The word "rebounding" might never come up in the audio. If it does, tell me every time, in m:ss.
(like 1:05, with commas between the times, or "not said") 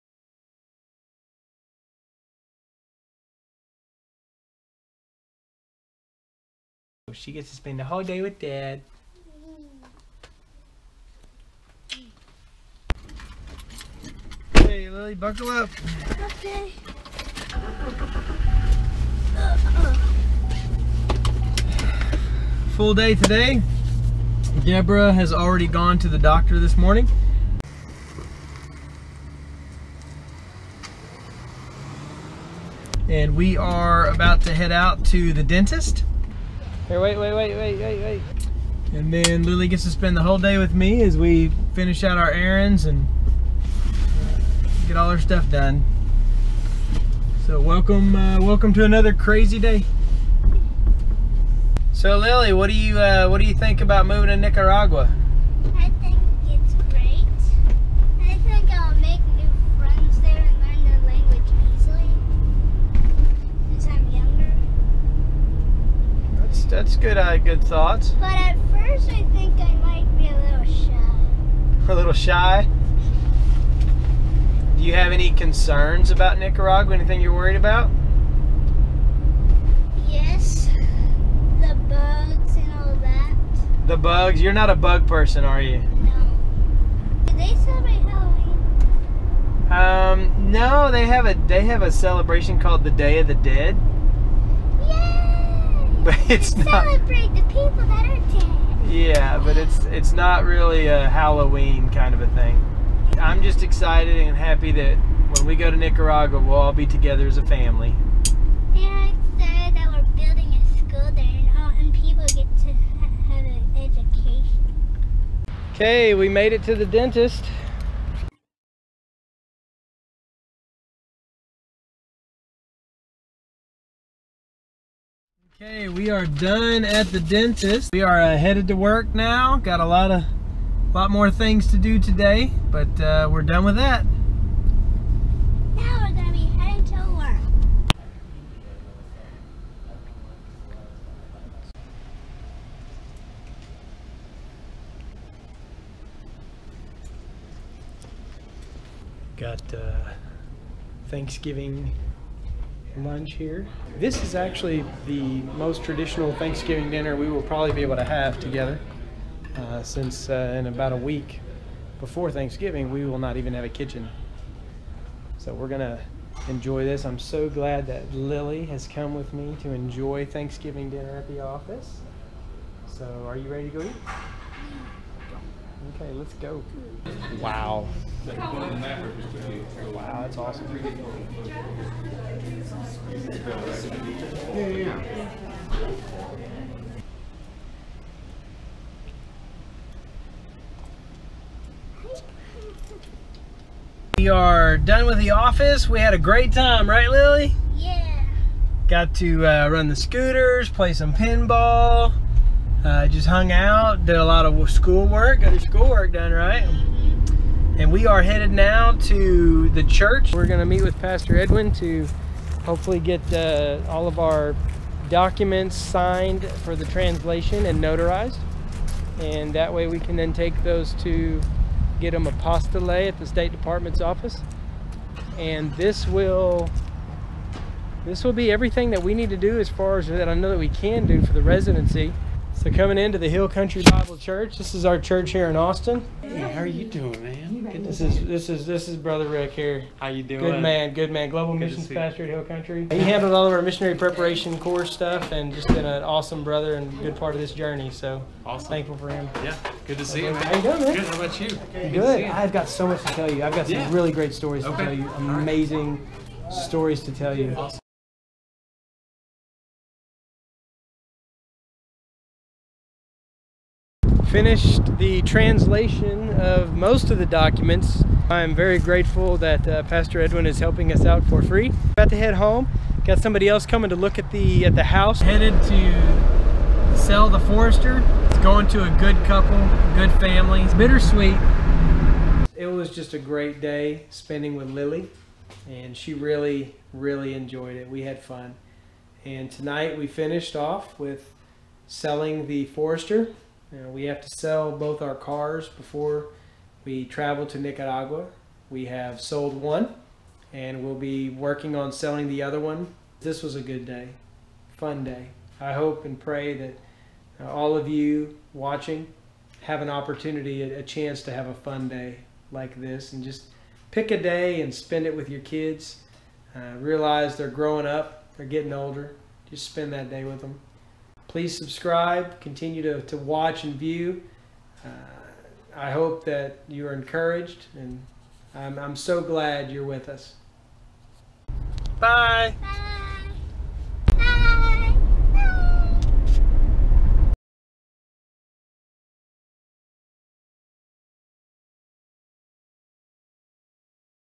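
not said.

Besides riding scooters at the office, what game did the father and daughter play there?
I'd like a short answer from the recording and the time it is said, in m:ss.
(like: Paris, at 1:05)
pinball, at 3:21.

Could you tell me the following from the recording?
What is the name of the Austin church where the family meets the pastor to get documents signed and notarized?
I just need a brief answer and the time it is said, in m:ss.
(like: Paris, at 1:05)
Hill Country Bible Church, at 3:53.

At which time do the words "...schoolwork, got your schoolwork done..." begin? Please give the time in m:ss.
3:24.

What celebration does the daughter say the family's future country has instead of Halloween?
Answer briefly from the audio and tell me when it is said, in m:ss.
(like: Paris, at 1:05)
Day of the Dead, at 1:32.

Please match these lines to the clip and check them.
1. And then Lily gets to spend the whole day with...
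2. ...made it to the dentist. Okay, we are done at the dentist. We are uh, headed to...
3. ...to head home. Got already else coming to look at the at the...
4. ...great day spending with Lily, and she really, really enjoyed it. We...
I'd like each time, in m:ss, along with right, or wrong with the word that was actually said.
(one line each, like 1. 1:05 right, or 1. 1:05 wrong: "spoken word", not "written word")
1. 0:38 right
2. 1:56 right
3. 4:32 wrong: "somebody", not "already"
4. 4:43 right.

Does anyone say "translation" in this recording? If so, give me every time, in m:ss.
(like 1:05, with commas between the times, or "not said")
3:36, 4:25.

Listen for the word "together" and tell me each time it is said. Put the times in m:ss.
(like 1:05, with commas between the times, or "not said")
1:46, 2:38.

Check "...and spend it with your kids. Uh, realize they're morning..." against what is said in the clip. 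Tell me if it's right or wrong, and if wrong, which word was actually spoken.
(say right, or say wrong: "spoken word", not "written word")
wrong: "growing", not "morning".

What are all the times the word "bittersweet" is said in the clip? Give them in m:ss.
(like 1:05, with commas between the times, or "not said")
4:40.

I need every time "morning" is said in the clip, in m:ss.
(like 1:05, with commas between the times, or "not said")
0:26.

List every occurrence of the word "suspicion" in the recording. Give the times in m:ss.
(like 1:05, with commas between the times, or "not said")
not said.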